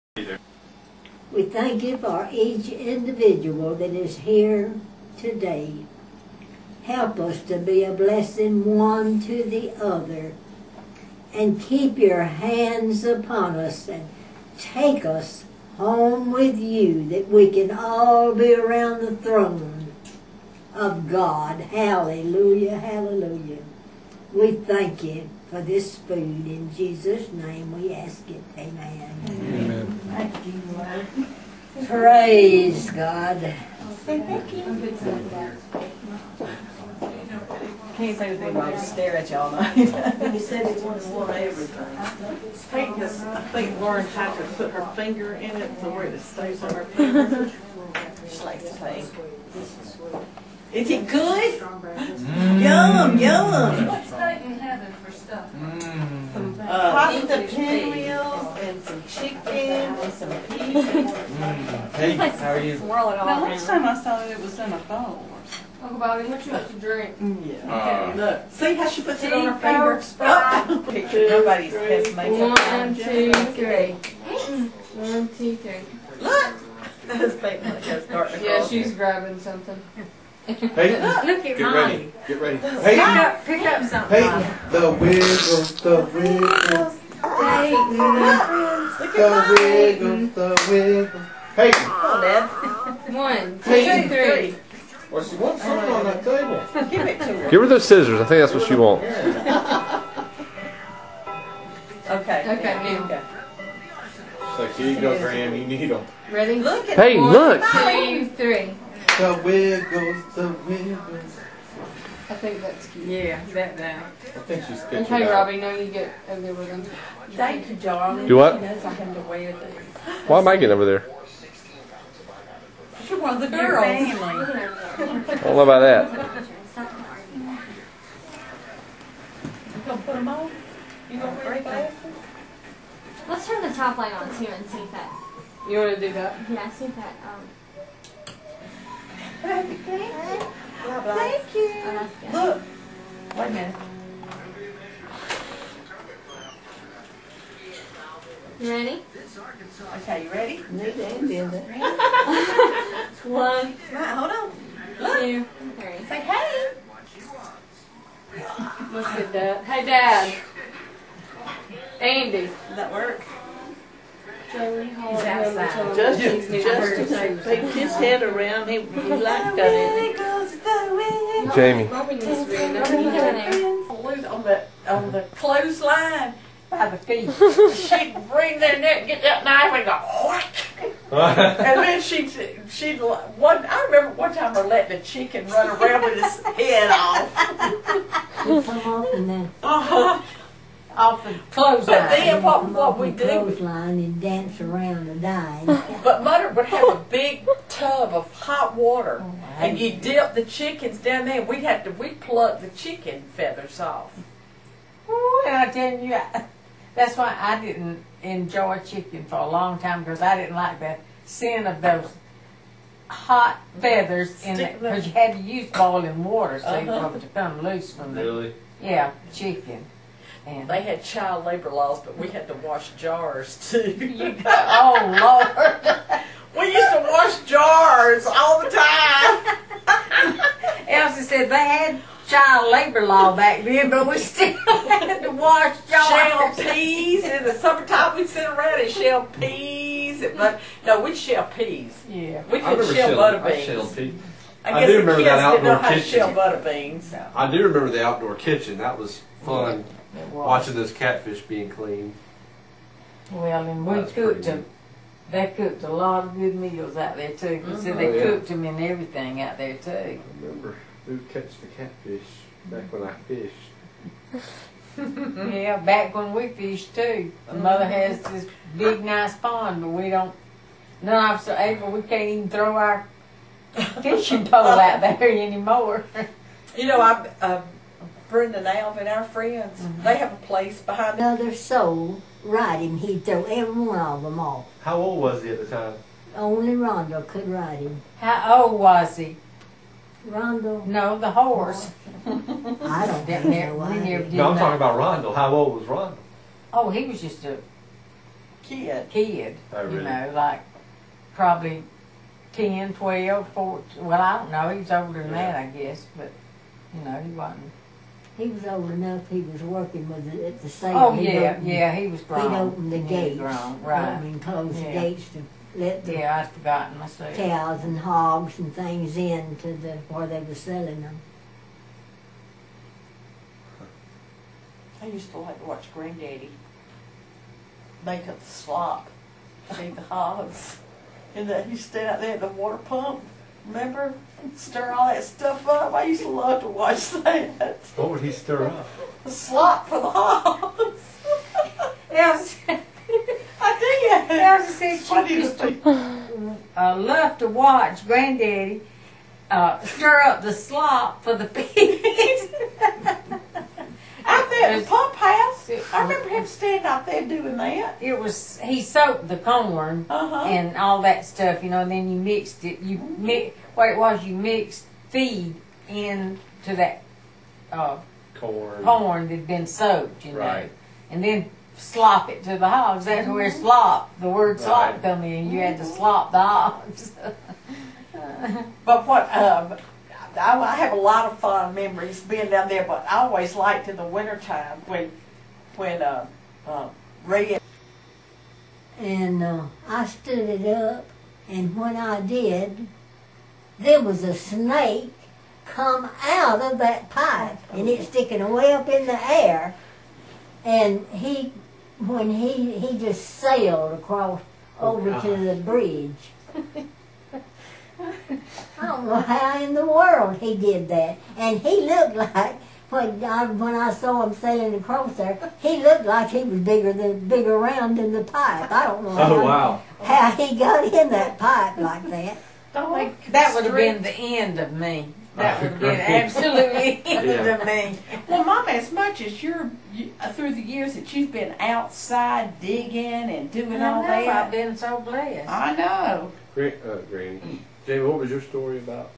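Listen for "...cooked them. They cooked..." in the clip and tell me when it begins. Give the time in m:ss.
4:14.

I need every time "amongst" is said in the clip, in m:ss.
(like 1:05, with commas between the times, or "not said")
not said.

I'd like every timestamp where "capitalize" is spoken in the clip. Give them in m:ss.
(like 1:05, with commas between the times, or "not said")
not said.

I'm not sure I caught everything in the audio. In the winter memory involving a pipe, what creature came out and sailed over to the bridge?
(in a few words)
snake.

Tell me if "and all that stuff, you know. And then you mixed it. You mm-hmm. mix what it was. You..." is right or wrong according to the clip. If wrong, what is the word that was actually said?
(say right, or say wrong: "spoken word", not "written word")
right.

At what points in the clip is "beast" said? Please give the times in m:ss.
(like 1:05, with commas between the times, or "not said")
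not said.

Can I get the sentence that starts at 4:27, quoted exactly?
My mother has this big nice pond, but we don't.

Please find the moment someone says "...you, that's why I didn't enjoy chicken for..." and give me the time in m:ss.
3:25.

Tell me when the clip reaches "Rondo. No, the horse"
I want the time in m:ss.
4:50.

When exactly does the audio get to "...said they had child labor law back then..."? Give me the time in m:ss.
3:51.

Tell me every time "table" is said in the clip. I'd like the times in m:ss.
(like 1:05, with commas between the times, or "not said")
1:36.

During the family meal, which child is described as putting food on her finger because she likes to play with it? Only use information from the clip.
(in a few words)
Lauren.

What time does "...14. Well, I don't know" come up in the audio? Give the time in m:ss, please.
5:03.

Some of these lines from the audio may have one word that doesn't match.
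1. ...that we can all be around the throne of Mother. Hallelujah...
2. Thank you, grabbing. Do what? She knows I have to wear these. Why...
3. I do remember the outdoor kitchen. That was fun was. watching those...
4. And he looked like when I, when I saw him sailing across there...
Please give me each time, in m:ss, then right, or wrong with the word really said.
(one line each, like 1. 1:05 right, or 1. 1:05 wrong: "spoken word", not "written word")
1. 0:17 wrong: "God", not "Mother"
2. 1:57 wrong: "darling", not "grabbing"
3. 4:07 right
4. 6:51 right.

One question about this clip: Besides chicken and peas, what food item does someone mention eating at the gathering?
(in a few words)
pinwheels.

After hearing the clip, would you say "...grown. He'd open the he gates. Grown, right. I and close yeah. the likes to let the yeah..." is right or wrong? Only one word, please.
wrong.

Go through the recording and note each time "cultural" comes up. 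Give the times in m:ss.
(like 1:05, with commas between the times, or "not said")
not said.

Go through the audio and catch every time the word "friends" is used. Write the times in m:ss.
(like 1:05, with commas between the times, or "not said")
1:27, 4:39.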